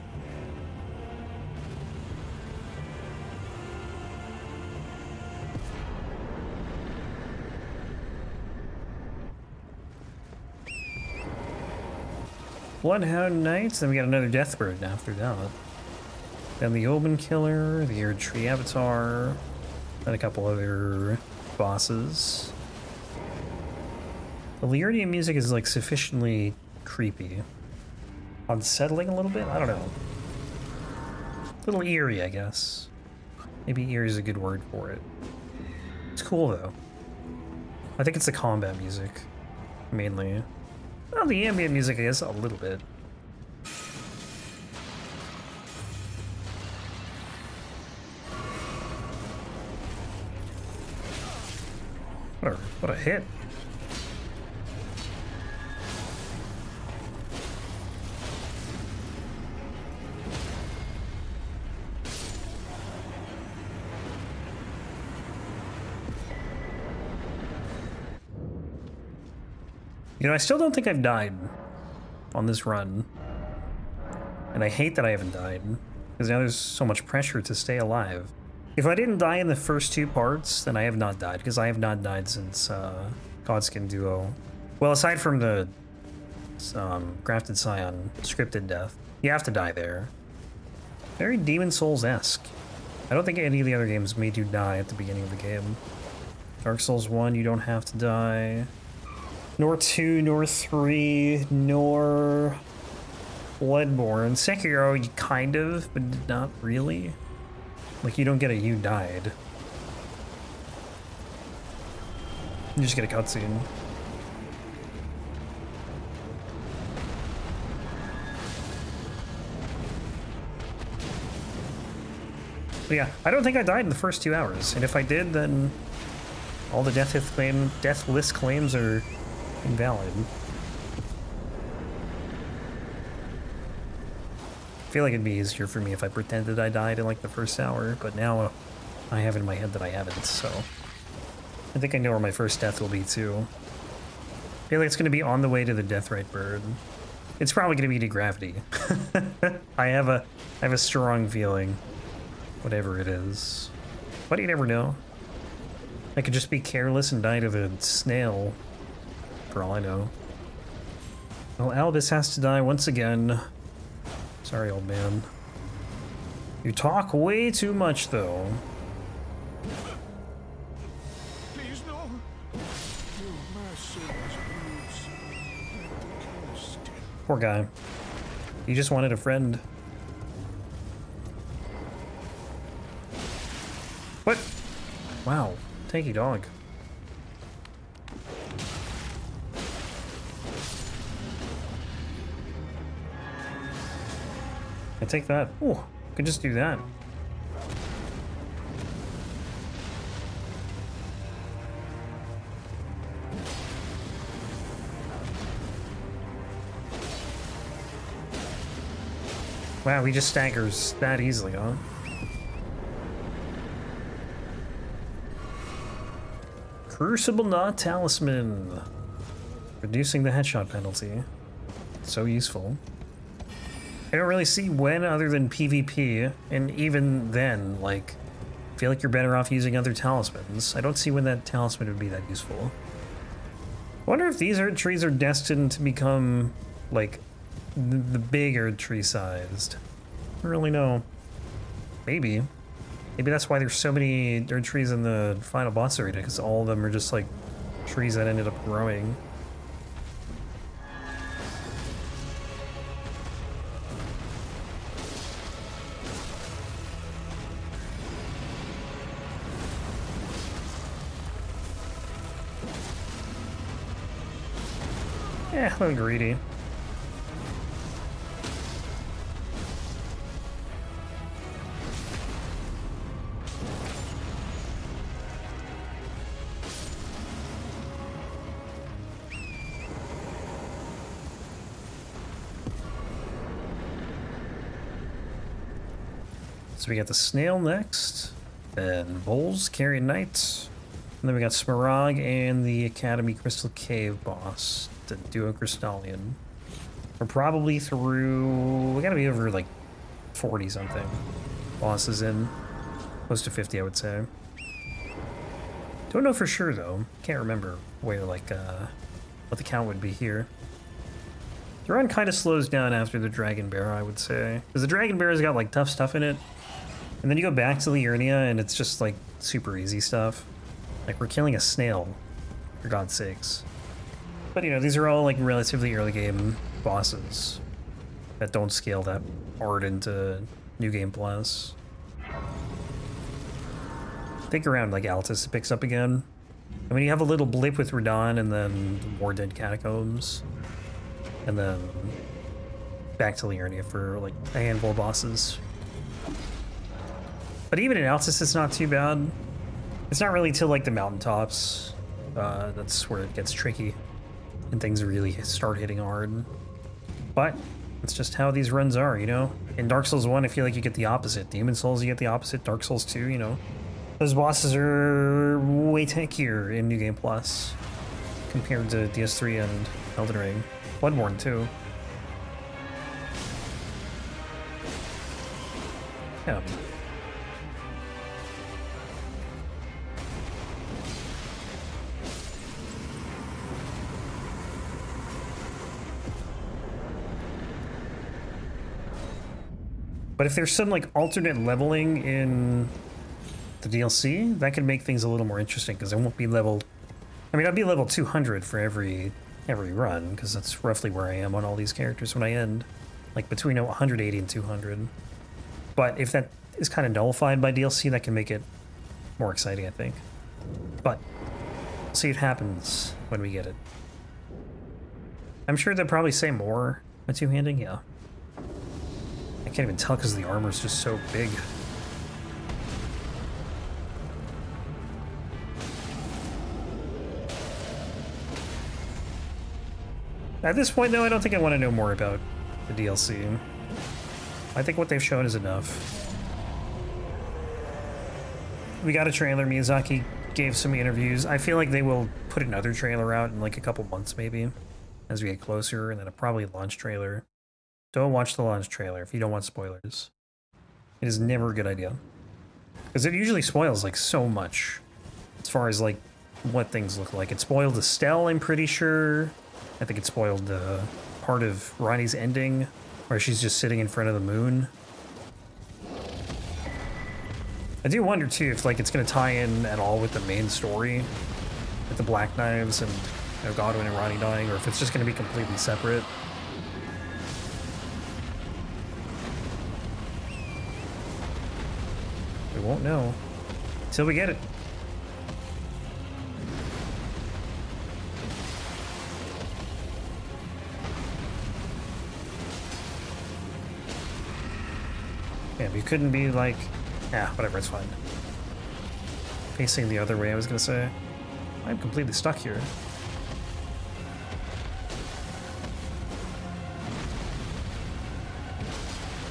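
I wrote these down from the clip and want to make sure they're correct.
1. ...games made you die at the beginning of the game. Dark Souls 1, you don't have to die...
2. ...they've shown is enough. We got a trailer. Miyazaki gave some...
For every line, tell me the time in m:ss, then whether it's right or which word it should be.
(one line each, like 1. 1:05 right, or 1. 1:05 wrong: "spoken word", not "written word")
1. 1:33 right
2. 7:15 right.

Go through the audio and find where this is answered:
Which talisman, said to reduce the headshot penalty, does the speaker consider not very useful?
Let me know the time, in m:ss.
3:36.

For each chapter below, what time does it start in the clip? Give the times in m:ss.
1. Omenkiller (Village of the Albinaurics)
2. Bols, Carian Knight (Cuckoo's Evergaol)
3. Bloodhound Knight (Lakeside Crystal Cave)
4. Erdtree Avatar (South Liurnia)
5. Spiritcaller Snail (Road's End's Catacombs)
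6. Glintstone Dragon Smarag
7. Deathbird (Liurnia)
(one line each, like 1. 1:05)
1. 3:03
2. 6:55
3. 0:44
4. 4:08
5. 6:03
6. 7:47
7. 1:51.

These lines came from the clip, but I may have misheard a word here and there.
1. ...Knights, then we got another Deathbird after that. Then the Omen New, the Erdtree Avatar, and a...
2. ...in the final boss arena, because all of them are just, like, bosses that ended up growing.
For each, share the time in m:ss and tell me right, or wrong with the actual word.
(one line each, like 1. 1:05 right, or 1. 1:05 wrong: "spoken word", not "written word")
1. 0:13 wrong: "Killer", not "New"
2. 4:04 wrong: "trees", not "bosses".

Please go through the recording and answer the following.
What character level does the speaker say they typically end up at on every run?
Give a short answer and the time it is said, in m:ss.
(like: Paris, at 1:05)
200, at 6:37.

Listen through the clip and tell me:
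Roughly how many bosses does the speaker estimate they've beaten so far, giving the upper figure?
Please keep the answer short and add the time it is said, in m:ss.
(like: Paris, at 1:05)
close to 50, at 5:03.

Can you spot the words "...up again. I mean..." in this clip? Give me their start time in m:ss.
5:35.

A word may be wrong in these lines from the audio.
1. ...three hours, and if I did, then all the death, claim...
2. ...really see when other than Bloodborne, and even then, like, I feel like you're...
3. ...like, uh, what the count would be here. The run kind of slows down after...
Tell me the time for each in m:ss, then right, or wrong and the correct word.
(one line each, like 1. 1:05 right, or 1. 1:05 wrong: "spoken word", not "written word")
1. 2:04 wrong: "two", not "three"
2. 3:44 wrong: "PvP", not "Bloodborne"
3. 5:08 right.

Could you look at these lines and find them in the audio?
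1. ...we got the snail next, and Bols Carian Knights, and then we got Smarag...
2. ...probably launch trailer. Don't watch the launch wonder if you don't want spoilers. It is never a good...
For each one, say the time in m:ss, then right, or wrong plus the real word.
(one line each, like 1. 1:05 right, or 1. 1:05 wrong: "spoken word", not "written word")
1. 4:46 right
2. 7:26 wrong: "trailer", not "wonder".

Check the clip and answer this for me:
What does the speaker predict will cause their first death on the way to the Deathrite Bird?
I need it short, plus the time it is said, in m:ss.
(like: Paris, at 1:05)
gravity, at 2:28.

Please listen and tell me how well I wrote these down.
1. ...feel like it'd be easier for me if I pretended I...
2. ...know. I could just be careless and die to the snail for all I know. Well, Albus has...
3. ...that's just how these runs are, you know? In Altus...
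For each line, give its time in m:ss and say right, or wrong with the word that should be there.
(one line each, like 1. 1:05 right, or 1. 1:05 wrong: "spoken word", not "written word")
1. 2:14 right
2. 2:34 right
3. 5:57 wrong: "Dark", not "Altus".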